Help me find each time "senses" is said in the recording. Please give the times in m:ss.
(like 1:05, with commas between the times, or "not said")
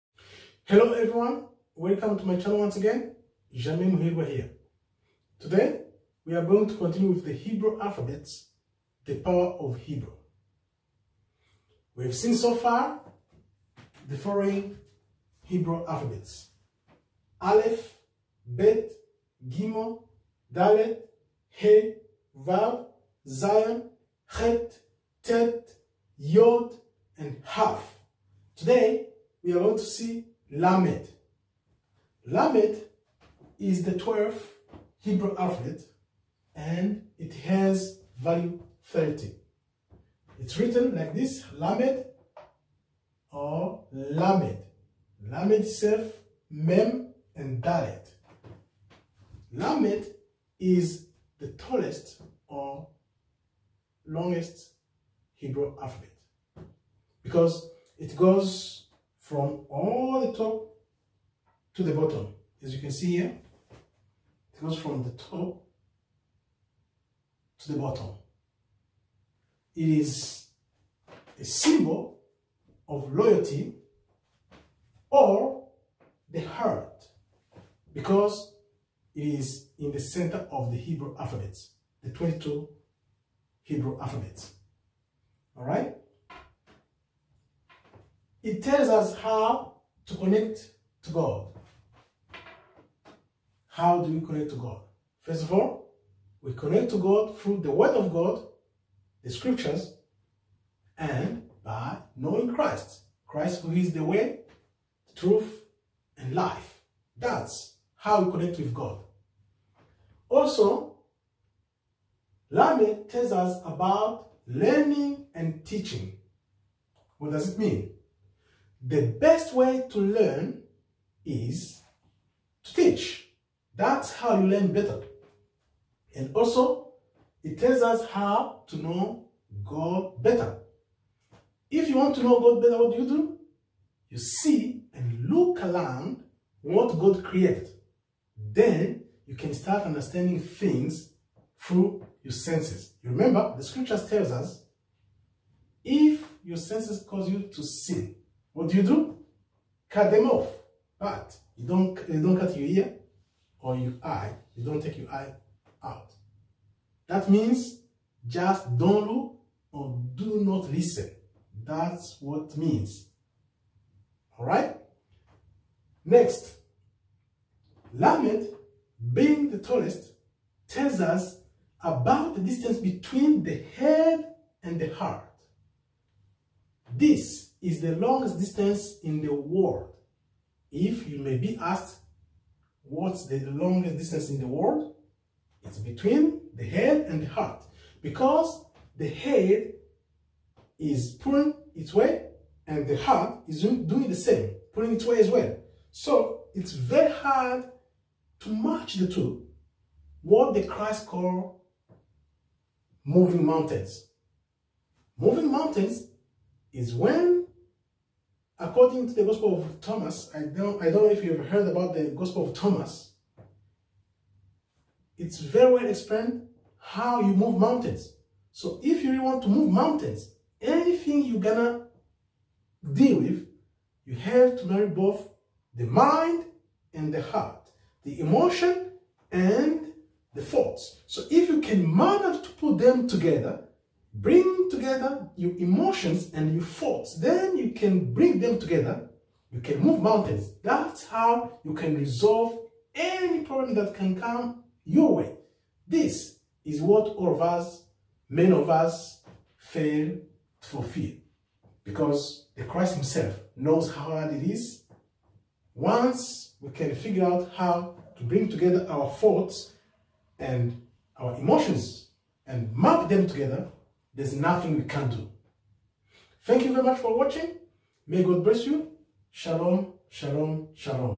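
2:22, 2:26.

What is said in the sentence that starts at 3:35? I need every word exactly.
It's very well explained how you move mountains.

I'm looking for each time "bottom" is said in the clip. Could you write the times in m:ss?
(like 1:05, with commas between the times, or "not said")
1:01, 1:07.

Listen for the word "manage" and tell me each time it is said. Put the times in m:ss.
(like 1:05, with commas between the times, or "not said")
3:51.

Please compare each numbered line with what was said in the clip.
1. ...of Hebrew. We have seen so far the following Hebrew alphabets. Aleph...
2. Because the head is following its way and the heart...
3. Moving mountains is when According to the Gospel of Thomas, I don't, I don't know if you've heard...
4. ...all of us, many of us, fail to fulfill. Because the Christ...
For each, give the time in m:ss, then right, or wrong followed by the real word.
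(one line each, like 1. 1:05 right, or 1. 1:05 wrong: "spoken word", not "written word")
1. 0:09 right
2. 3:08 wrong: "pulling", not "following"
3. 3:25 right
4. 4:07 right.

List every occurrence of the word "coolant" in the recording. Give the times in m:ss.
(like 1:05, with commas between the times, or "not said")
not said.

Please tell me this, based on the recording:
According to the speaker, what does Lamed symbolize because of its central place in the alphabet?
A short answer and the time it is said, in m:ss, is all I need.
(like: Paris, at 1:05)
Loyalty, at 1:13.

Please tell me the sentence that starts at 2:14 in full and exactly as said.
You see and look around what God created.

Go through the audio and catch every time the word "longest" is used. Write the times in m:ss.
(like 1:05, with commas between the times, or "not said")
0:54, 2:57, 3:03.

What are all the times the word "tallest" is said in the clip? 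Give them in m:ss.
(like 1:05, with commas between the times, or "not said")
0:51, 2:49.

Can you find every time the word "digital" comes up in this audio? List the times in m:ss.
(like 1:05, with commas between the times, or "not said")
not said.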